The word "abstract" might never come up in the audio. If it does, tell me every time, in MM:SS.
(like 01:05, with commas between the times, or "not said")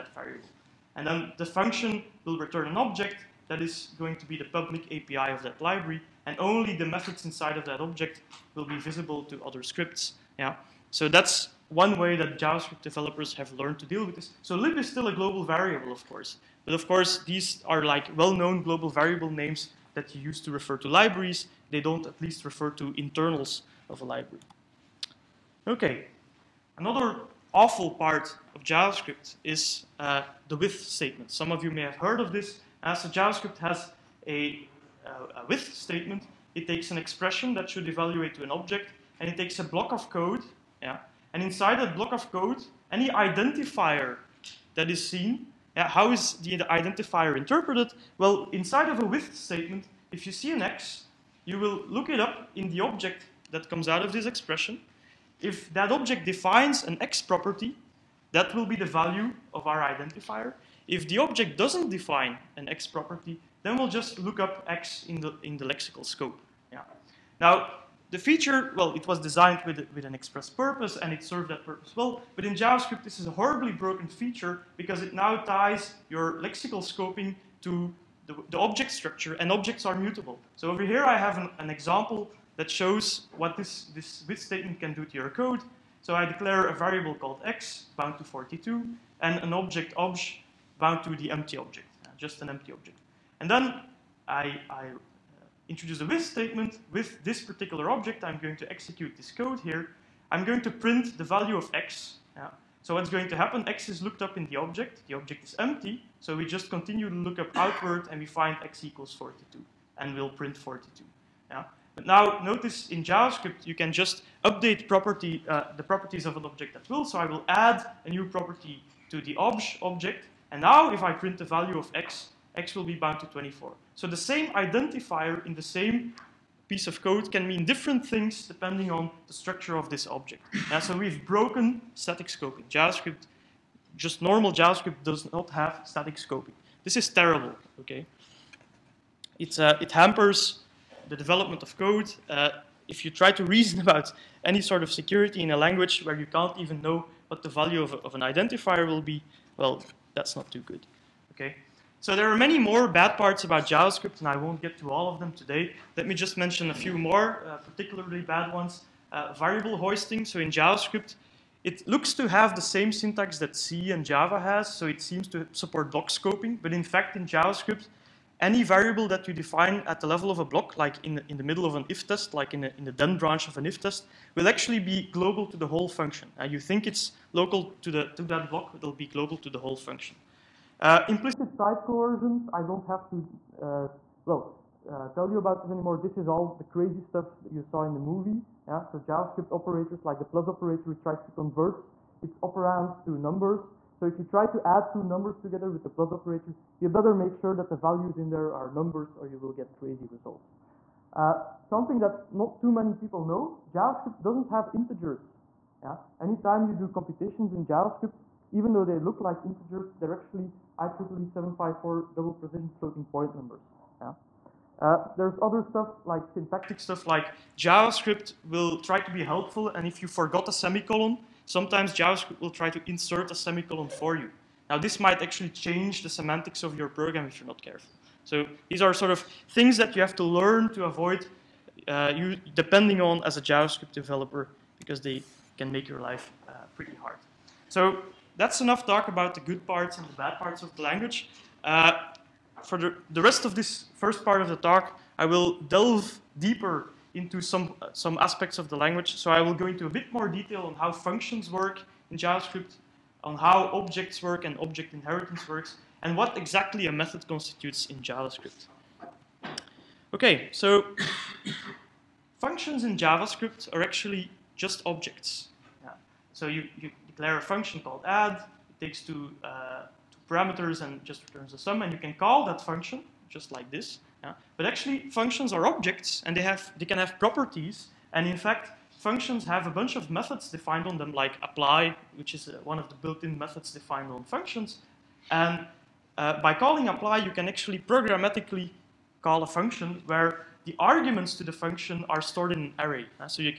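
not said.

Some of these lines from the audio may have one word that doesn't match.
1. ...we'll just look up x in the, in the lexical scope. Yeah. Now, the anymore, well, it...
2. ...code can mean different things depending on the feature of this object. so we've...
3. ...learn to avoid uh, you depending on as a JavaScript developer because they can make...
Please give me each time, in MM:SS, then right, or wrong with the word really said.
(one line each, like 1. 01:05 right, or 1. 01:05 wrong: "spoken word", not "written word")
1. 01:03 wrong: "feature", not "anymore"
2. 02:07 wrong: "structure", not "feature"
3. 03:50 right.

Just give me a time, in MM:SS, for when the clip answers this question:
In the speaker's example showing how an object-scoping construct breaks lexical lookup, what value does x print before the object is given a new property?
01:50.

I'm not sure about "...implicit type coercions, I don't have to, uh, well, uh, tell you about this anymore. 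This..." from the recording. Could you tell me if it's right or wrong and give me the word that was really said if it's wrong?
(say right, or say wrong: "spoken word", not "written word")
right.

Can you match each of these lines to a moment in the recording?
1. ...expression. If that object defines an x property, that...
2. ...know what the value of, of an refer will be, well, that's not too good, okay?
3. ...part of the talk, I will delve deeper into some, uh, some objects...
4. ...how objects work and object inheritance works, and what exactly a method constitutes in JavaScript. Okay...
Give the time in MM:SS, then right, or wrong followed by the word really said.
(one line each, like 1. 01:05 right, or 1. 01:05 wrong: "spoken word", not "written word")
1. 00:54 right
2. 02:26 wrong: "identifier", not "refer"
3. 04:04 wrong: "aspects", not "objects"
4. 04:13 right.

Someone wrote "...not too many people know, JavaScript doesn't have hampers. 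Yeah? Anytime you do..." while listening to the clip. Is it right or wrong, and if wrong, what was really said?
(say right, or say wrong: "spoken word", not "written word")
wrong: "integers", not "hampers".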